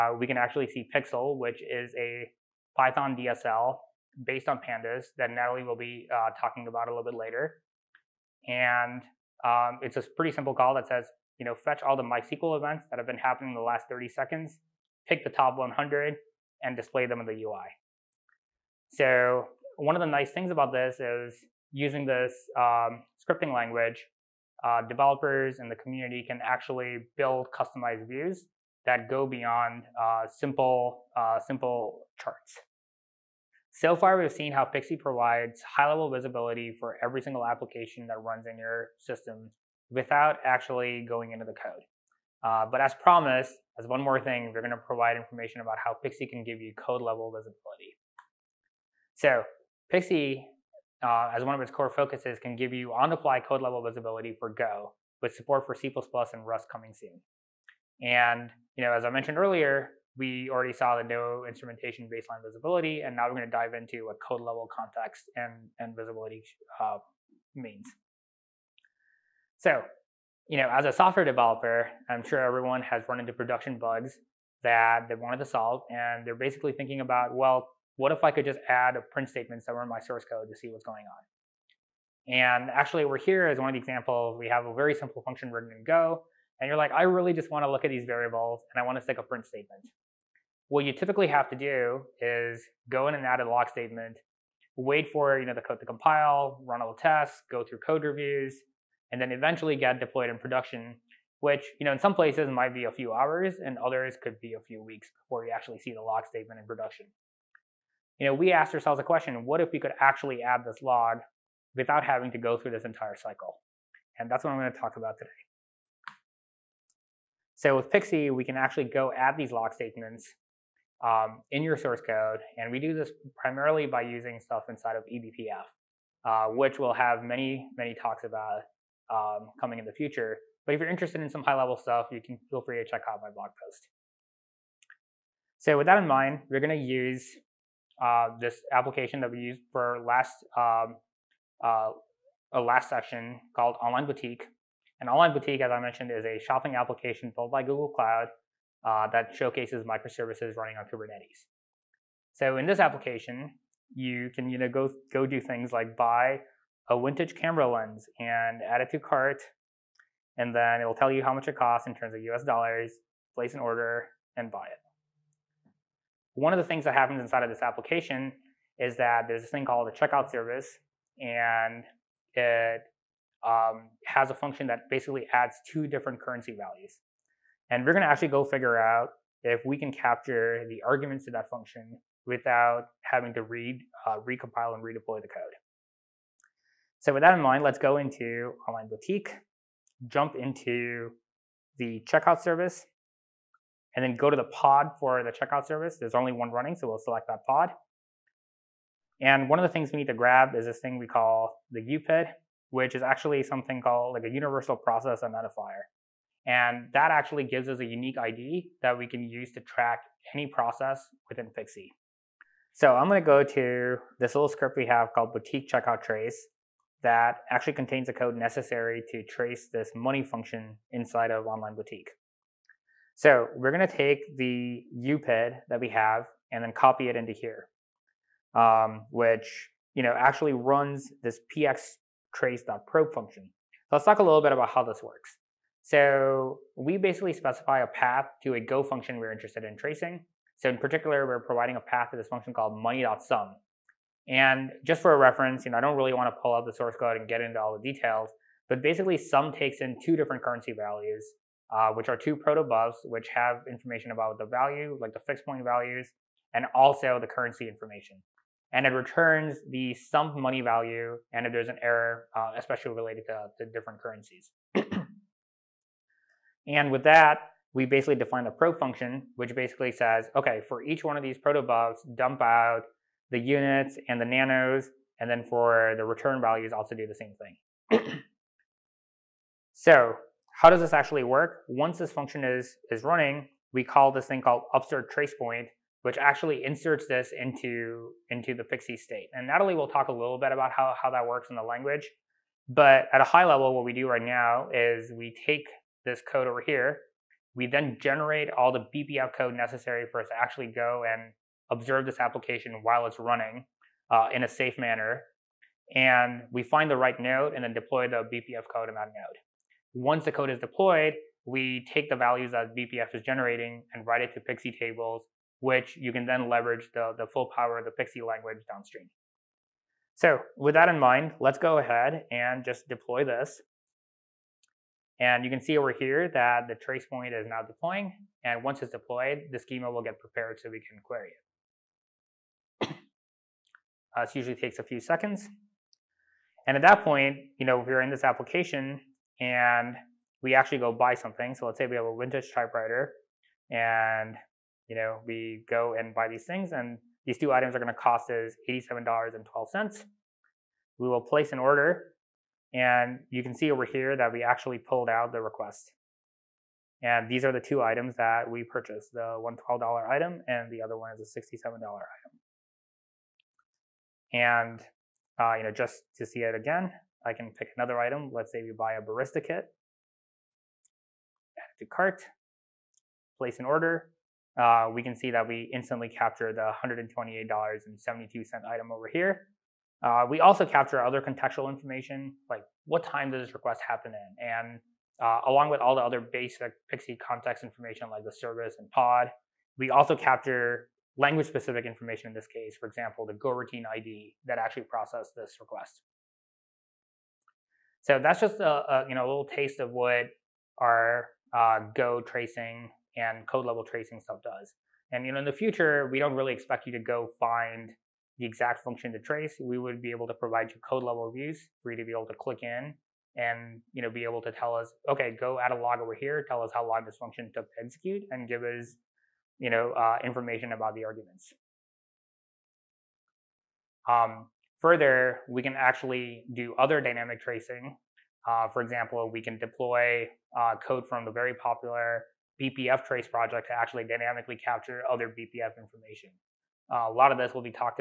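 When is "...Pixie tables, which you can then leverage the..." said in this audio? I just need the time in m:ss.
5:14.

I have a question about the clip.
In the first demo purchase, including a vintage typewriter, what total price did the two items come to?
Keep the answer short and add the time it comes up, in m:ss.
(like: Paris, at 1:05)
$87.12, at 5:48.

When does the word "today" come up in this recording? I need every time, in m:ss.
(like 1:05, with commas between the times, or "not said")
1:55.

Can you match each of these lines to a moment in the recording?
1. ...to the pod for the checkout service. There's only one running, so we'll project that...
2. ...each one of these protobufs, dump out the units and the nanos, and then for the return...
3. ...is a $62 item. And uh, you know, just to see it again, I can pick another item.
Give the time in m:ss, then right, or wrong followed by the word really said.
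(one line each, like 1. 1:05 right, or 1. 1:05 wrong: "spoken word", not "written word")
1. 3:14 wrong: "select", not "project"
2. 4:30 right
3. 6:01 wrong: "67", not "62".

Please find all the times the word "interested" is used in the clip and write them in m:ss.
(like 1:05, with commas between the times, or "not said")
2:10, 3:59.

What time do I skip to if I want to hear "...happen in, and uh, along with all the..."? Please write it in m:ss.
6:23.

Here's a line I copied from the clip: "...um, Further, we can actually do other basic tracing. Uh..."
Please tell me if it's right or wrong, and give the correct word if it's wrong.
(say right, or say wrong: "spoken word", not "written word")
wrong: "dynamic", not "basic".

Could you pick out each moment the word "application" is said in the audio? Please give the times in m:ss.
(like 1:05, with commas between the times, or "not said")
0:37, 2:18, 2:26, 2:32, 2:47, 5:02, 5:38.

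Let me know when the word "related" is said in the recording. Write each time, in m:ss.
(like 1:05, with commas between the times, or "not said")
4:22.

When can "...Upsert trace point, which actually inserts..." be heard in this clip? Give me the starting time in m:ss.
4:44.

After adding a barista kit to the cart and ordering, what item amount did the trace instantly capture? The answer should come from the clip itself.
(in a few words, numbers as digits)
$128.72.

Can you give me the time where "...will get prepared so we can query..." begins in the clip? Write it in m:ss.
5:29.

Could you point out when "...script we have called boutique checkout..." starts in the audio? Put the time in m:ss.
3:34.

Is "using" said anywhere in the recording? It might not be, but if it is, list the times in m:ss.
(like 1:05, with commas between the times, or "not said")
0:21, 2:04.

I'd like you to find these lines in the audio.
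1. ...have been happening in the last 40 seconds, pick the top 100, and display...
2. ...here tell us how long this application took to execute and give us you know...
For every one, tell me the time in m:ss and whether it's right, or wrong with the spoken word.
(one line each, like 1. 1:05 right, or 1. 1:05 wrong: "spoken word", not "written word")
1. 0:12 wrong: "30", not "40"
2. 6:56 wrong: "function", not "application".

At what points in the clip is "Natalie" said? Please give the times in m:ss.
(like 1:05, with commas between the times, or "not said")
0:05, 4:49.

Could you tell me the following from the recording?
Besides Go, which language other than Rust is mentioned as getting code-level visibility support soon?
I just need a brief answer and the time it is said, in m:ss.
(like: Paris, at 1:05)
C++, at 0:55.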